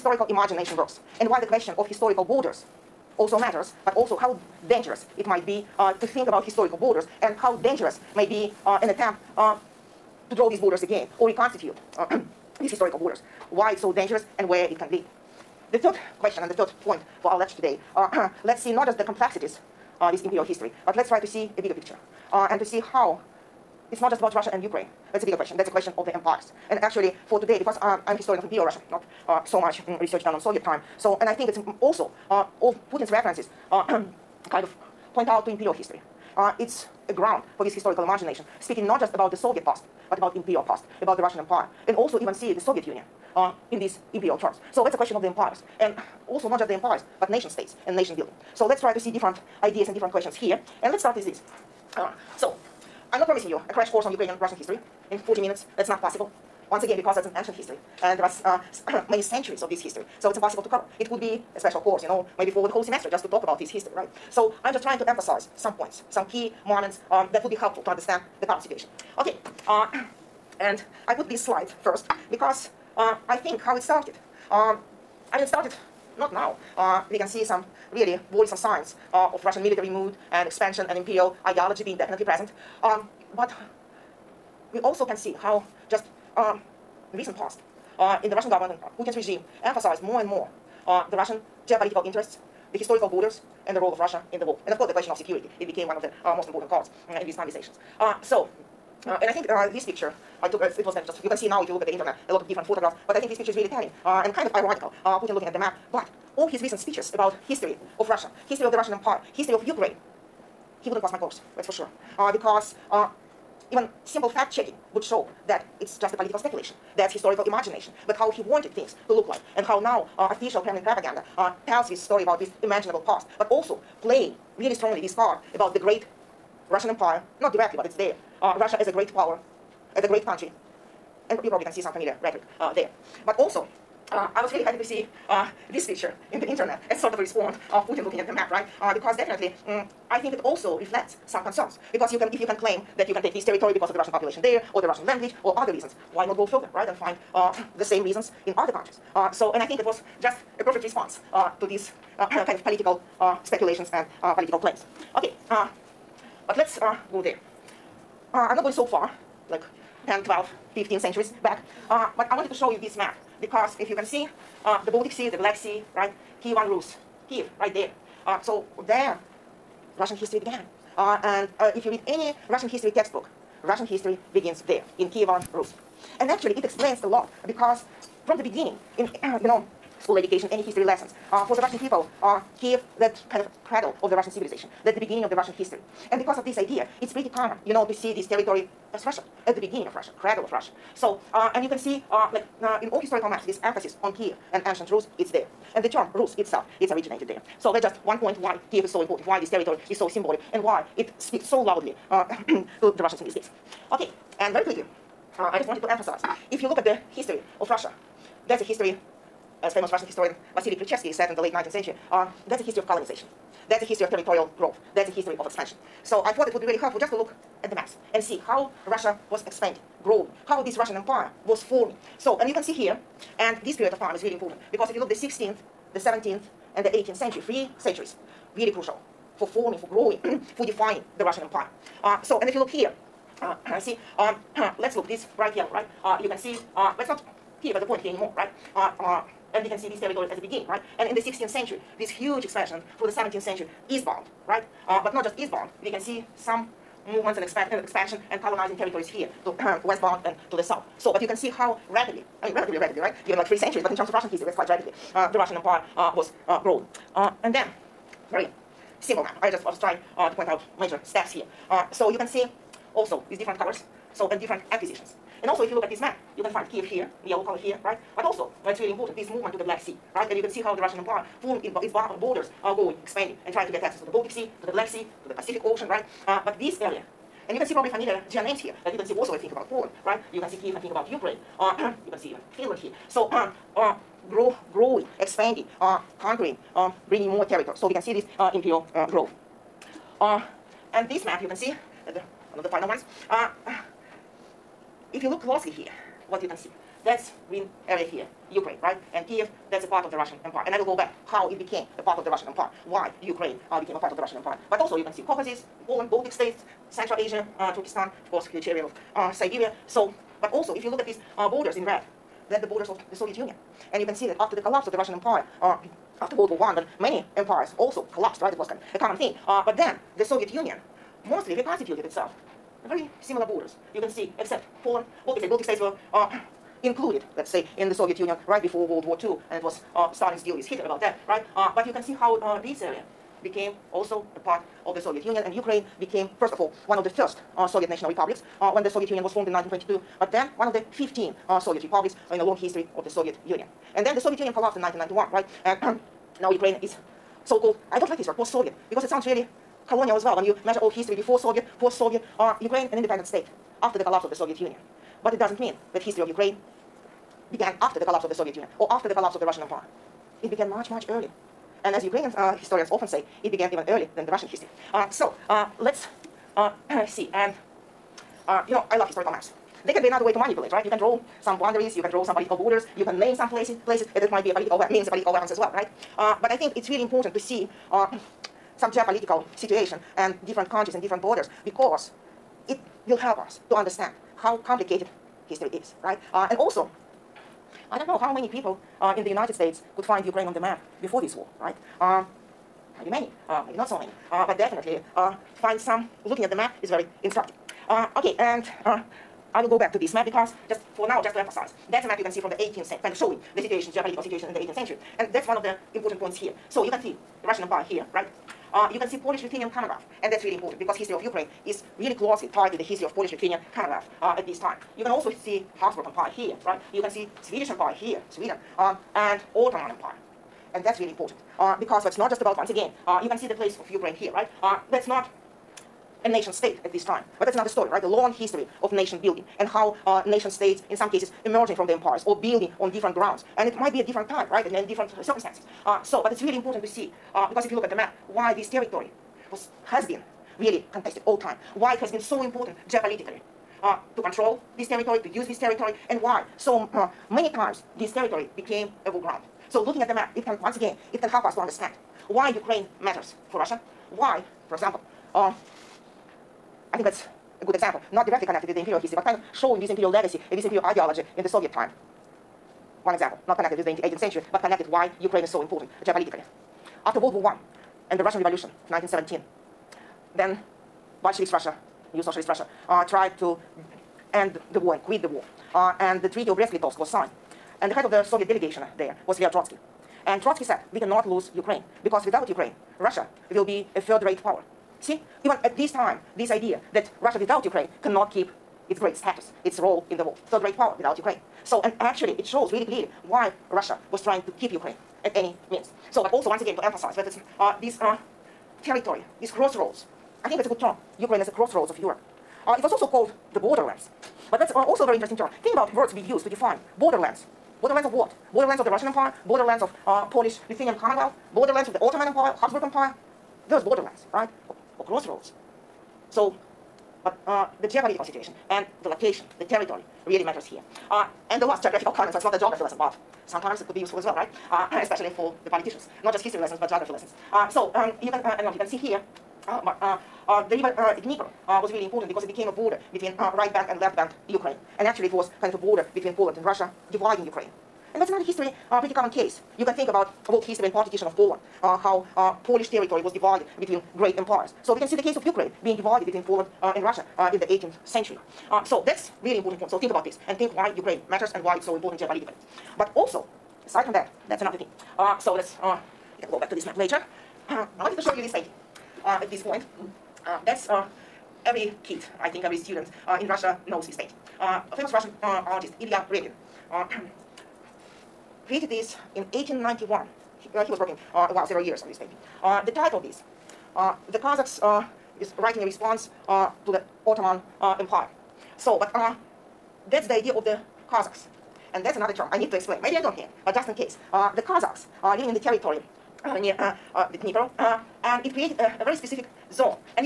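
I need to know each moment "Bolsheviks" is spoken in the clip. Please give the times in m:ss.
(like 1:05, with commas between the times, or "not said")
7:51.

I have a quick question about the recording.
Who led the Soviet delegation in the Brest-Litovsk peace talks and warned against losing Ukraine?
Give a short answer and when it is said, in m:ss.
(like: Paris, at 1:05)
Leo Trotsky, at 7:59.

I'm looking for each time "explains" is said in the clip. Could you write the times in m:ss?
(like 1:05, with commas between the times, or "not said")
2:56, 9:42.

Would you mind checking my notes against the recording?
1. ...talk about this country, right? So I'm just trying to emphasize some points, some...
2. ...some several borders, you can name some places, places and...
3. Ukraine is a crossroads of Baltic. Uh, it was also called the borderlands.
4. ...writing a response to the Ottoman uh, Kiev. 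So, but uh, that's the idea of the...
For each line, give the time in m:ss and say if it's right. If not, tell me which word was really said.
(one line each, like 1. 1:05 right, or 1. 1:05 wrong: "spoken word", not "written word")
1. 1:03 wrong: "history", not "country"
2. 6:12 wrong: "political", not "several"
3. 8:21 wrong: "Europe", not "Baltic"
4. 9:35 wrong: "Empire", not "Kiev".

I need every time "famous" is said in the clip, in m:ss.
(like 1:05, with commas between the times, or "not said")
3:29, 9:24.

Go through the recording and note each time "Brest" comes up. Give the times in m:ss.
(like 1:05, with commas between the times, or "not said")
7:56.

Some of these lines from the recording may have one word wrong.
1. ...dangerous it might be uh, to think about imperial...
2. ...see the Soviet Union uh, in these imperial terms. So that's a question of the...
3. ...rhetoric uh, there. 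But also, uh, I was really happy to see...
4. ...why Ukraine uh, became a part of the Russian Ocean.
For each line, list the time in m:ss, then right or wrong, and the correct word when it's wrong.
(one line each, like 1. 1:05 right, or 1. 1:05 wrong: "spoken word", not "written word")
1. 0:04 wrong: "historical", not "imperial"
2. 0:42 right
3. 2:12 right
4. 5:02 wrong: "Empire", not "Ocean".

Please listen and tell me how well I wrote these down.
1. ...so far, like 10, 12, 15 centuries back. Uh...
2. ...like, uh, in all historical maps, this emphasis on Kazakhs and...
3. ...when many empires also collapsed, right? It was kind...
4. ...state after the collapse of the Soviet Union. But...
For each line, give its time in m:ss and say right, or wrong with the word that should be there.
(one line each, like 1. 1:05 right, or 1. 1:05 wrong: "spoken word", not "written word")
1. 2:38 right
2. 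3:12 wrong: "Kiev", not "Kazakhs"
3. 5:16 right
4. 5:53 right.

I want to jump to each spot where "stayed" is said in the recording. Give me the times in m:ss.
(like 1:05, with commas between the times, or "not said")
not said.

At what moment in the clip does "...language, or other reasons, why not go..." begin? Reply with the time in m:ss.
2:25.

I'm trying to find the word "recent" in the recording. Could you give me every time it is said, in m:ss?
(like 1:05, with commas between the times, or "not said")
1:27, 1:46.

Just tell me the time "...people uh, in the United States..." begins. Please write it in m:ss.
6:28.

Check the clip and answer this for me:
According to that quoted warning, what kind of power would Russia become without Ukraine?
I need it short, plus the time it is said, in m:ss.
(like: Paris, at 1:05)
third-rate power, at 8:03.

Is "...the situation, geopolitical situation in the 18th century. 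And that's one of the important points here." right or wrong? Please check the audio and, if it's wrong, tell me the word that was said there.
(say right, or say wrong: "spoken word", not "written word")
right.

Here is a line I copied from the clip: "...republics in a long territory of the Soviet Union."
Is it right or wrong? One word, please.
wrong.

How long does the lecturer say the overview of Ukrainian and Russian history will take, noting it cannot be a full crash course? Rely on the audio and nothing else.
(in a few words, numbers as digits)
40 minutes.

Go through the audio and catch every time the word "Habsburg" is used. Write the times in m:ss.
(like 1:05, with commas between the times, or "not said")
6:55, 8:32.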